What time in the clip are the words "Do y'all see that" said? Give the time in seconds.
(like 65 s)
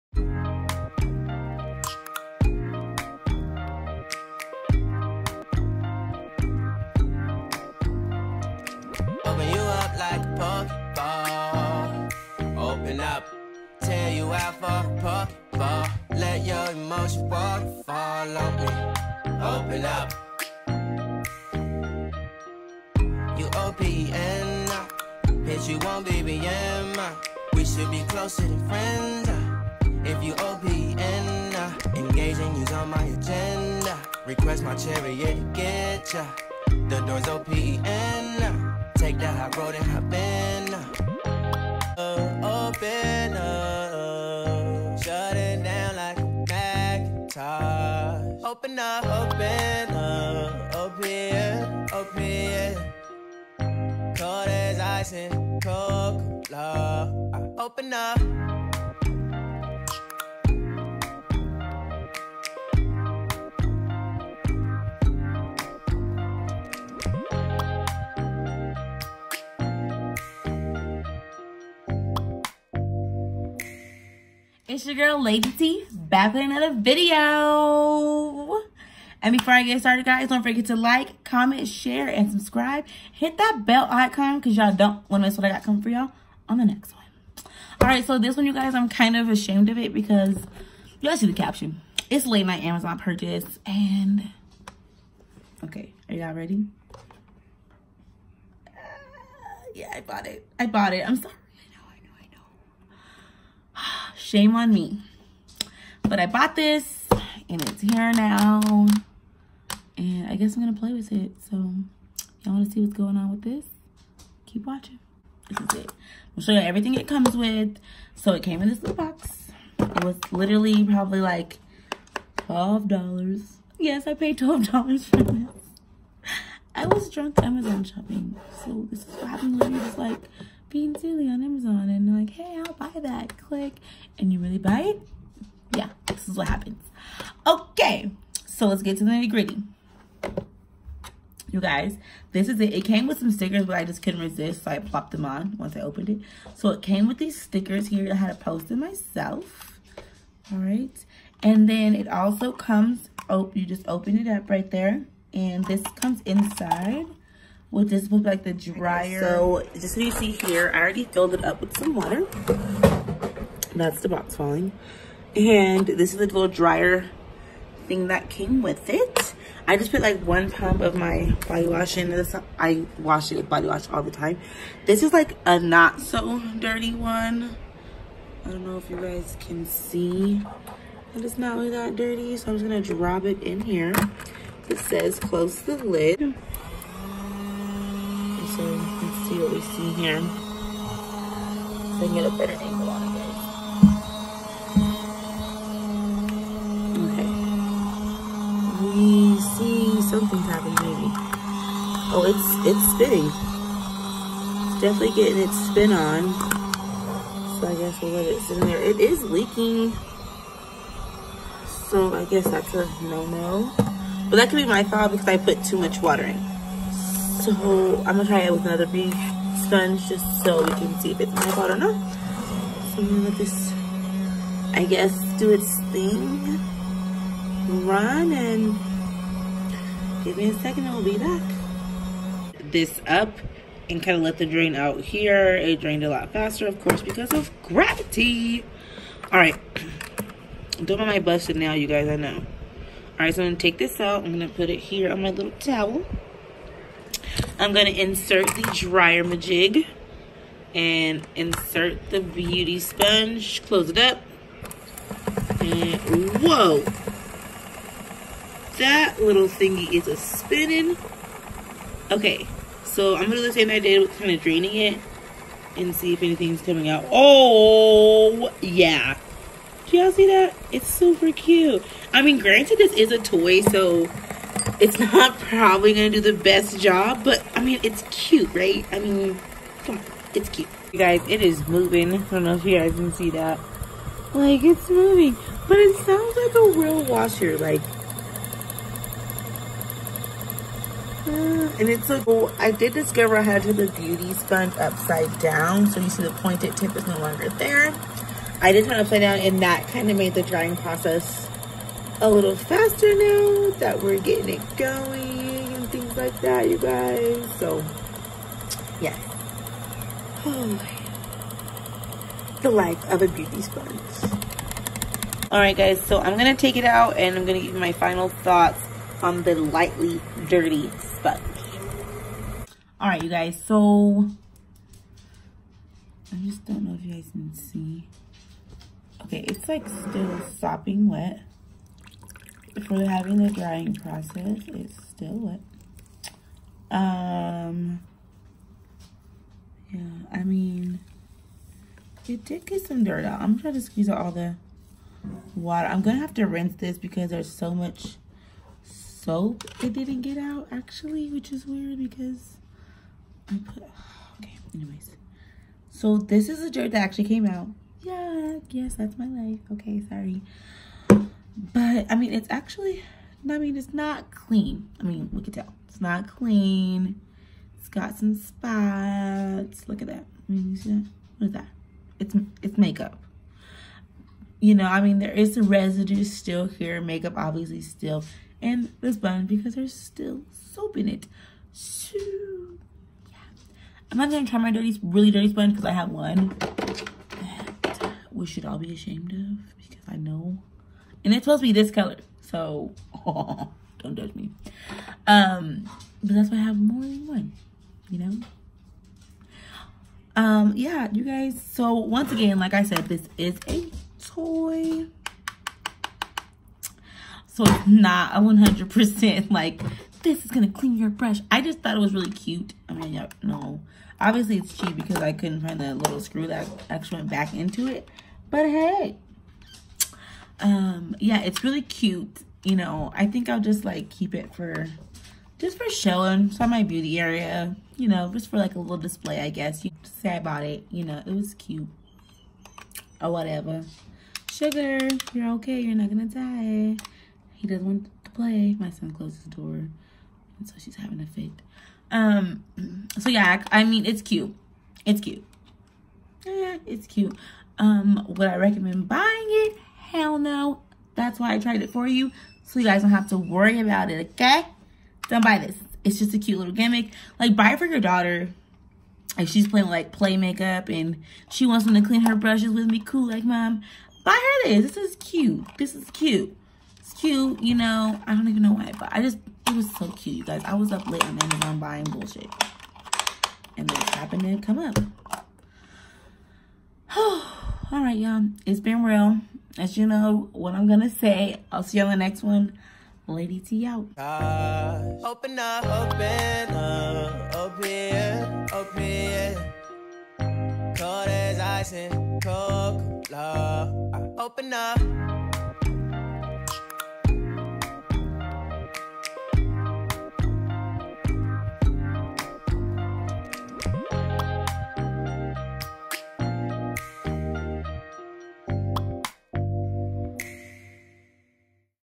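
269 s.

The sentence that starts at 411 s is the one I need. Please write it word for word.
I just thought it was really cute.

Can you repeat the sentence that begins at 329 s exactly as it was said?
Okay, it's like still sopping wet.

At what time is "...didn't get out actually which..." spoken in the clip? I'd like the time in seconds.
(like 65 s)
349 s.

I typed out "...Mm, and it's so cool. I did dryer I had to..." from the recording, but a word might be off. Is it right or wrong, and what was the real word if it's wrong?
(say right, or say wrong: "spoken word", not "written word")
wrong: "discover", not "dryer".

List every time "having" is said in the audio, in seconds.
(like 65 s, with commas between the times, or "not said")
333 s, 440 s.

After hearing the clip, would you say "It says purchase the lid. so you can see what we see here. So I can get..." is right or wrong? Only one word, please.
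wrong.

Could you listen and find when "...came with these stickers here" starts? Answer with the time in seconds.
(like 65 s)
146 s.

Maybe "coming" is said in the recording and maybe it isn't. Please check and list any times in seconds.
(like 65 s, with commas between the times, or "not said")
85 s, 266 s.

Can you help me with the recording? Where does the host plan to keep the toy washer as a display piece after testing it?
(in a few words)
beauty area.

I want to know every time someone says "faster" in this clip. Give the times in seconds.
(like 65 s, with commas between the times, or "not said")
236 s, 302 s.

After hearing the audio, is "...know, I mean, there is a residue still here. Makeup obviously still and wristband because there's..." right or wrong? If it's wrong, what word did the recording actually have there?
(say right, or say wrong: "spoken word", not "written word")
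right.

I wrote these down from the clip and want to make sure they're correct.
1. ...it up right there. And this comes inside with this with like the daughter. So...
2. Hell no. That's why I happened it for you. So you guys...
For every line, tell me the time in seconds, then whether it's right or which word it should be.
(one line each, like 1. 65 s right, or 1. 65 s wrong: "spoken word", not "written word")
1. 154 s wrong: "dryer", not "daughter"
2. 449 s wrong: "tried", not "happened".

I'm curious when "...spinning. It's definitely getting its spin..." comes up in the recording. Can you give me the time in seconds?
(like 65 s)
202 s.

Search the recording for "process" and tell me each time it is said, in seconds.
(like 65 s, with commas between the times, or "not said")
300 s, 333 s.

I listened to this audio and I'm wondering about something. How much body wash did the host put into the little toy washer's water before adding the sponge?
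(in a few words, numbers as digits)
one pump.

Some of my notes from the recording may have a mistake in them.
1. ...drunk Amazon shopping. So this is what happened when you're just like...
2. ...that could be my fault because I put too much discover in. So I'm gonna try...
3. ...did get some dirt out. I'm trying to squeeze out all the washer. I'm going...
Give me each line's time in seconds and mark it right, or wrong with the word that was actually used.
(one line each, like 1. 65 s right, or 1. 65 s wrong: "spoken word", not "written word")
1. 127 s right
2. 214 s wrong: "water", not "discover"
3. 342 s wrong: "water", not "washer".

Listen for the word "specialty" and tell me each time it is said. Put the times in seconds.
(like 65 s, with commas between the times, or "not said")
not said.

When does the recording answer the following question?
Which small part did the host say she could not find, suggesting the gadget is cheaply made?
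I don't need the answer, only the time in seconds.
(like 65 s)
415 s.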